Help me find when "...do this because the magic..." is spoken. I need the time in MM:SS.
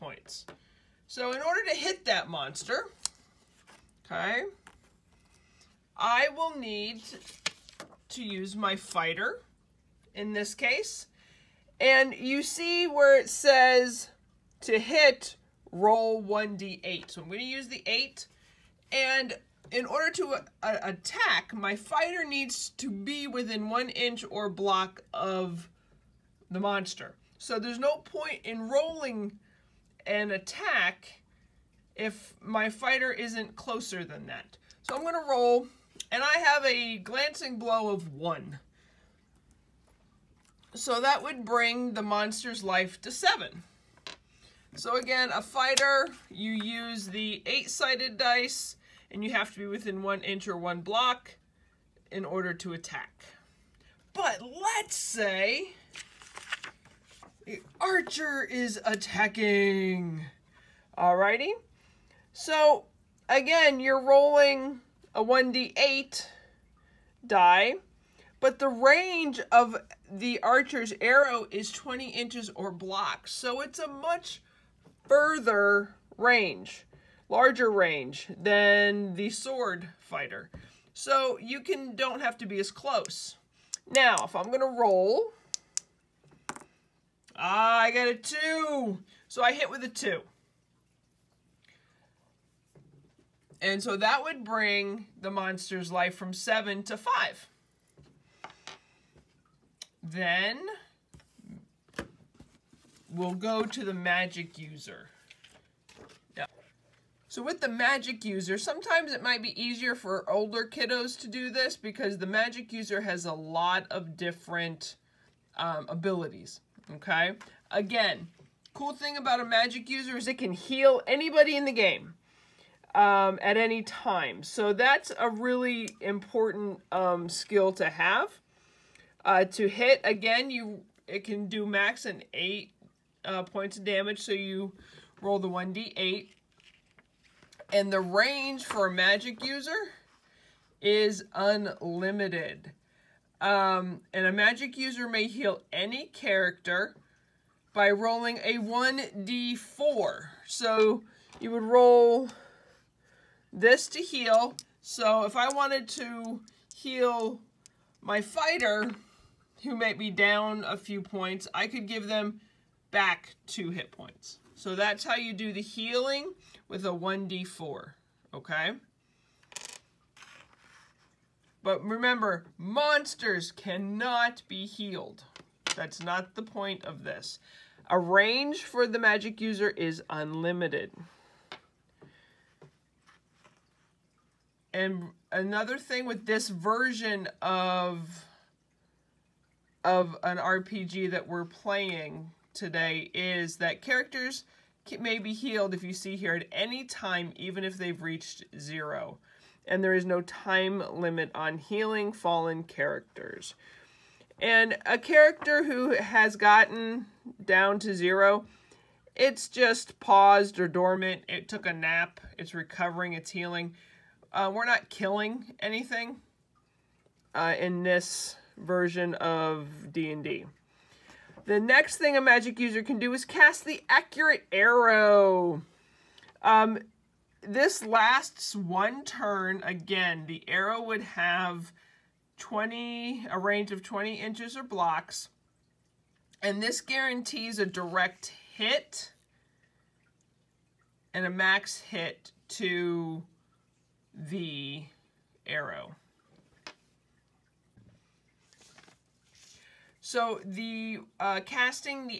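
01:51.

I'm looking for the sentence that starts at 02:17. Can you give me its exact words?
And the range for a magic user is unlimited.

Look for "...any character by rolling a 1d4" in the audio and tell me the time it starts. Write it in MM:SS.
02:25.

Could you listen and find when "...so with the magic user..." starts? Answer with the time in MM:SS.
01:47.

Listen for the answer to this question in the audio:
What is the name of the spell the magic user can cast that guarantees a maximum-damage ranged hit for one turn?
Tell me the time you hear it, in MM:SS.
03:43.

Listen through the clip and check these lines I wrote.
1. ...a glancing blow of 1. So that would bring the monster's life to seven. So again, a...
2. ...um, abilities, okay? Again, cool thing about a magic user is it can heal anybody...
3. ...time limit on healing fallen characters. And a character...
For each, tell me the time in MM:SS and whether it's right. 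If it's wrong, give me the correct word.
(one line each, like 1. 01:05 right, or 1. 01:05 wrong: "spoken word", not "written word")
1. 00:36 right
2. 01:55 right
3. 03:20 right.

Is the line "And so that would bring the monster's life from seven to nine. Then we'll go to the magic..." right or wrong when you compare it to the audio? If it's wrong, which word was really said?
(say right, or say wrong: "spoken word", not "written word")
wrong: "five", not "nine".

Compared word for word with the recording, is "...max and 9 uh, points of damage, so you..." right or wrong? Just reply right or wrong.
wrong.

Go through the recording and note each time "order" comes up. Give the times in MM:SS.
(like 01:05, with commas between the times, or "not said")
00:01, 00:19, 00:52.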